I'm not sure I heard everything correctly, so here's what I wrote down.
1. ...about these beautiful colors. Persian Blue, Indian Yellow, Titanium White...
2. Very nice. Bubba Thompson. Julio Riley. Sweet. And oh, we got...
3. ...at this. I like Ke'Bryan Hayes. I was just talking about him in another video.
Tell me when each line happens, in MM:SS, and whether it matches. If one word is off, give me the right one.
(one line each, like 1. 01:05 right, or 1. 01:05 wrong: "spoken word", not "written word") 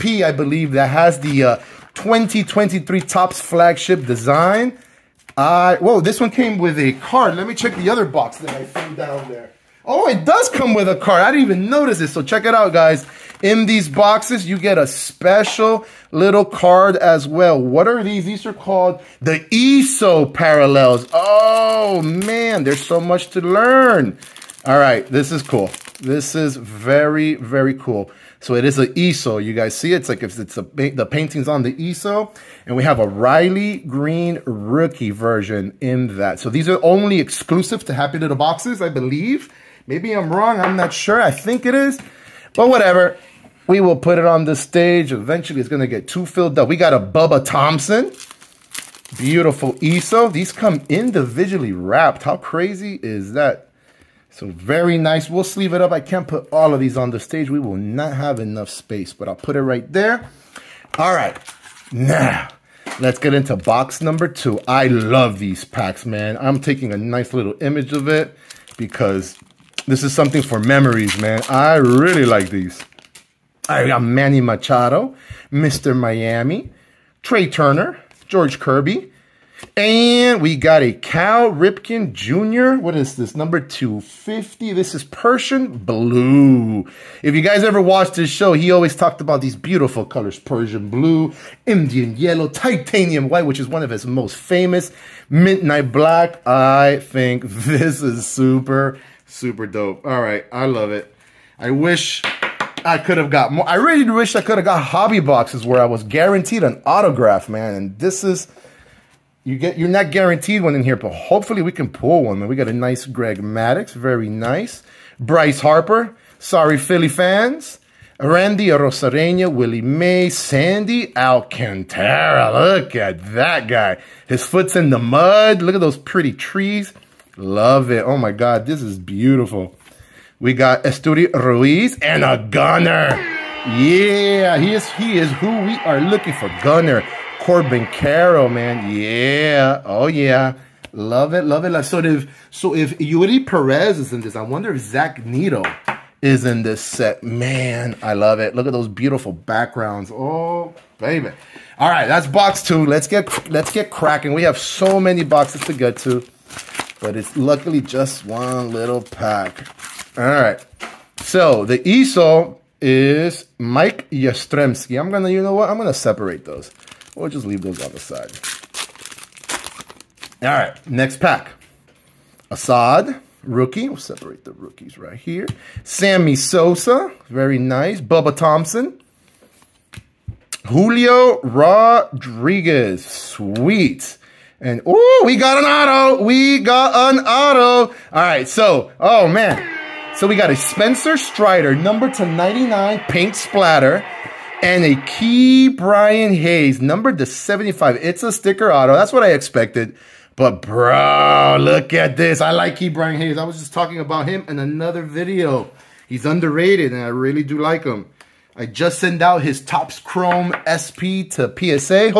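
1. 01:29 right
2. 02:57 wrong: "Rodriguez", not "Riley"
3. 03:21 right.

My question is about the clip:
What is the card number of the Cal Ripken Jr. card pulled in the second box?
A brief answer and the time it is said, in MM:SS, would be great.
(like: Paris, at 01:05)
250, at 01:23.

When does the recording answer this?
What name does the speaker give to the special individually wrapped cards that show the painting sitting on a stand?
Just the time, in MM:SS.
00:19.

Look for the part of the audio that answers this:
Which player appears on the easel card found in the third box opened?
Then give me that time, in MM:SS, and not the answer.
02:43.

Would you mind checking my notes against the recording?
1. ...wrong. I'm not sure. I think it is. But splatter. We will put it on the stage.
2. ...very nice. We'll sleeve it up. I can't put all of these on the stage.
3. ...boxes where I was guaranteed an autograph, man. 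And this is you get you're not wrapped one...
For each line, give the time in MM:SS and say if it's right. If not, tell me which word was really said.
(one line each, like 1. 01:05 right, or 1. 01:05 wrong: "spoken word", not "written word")
1. 00:40 wrong: "whatever", not "splatter"
2. 00:54 right
3. 01:45 wrong: "guaranteed", not "wrapped".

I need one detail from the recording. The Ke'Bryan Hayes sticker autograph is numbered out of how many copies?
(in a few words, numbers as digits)
75.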